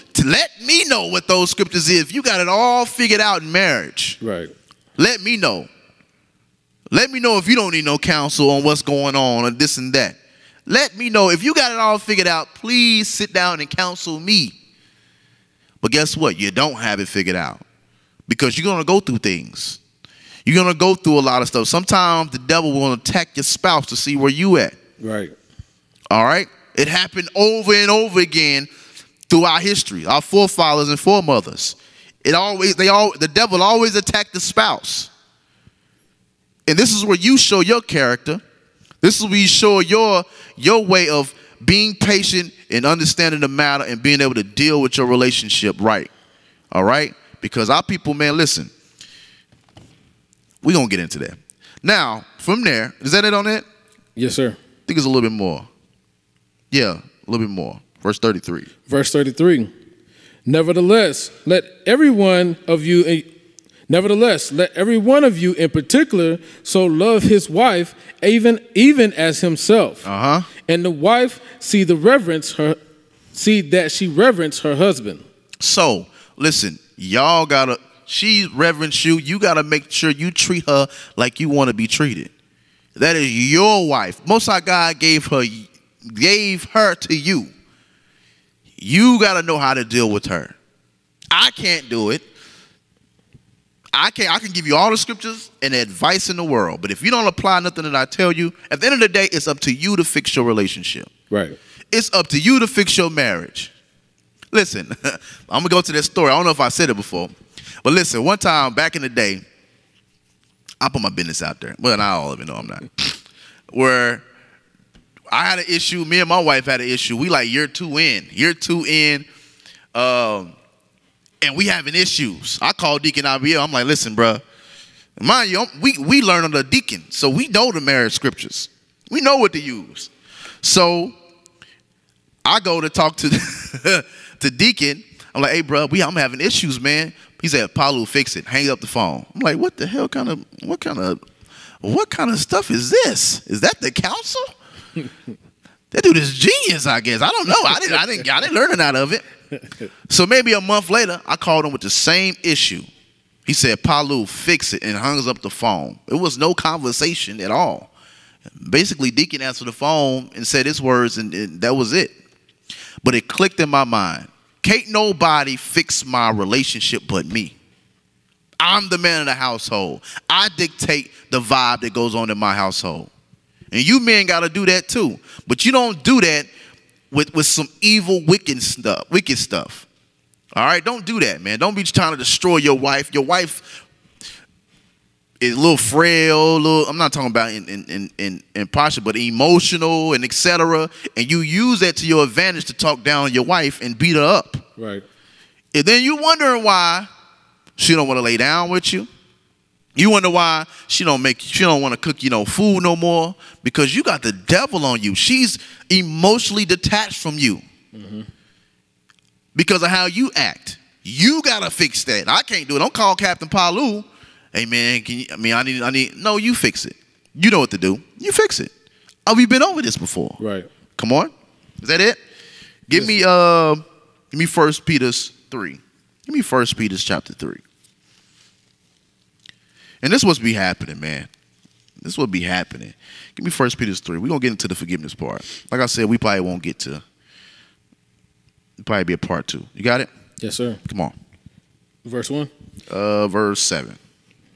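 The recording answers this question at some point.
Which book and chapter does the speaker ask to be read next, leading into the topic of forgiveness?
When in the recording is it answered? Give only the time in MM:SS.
03:53.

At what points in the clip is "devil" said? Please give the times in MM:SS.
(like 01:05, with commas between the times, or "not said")
00:22, 00:33, 03:24.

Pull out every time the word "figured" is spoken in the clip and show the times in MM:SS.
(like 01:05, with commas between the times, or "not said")
00:02, 00:11, 00:17.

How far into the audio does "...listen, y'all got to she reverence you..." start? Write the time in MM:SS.
01:16.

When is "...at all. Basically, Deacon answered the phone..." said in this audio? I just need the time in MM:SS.
02:37.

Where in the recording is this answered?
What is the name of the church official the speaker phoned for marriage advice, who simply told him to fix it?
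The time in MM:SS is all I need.
02:03.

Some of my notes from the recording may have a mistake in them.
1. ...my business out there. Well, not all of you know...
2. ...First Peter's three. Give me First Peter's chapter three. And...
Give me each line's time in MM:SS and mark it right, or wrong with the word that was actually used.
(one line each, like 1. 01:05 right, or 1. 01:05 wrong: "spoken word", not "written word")
1. 01:51 right
2. 03:44 right.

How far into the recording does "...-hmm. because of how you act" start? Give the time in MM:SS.
03:28.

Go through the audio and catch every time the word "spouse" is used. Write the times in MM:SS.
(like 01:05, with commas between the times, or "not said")
00:23, 00:34.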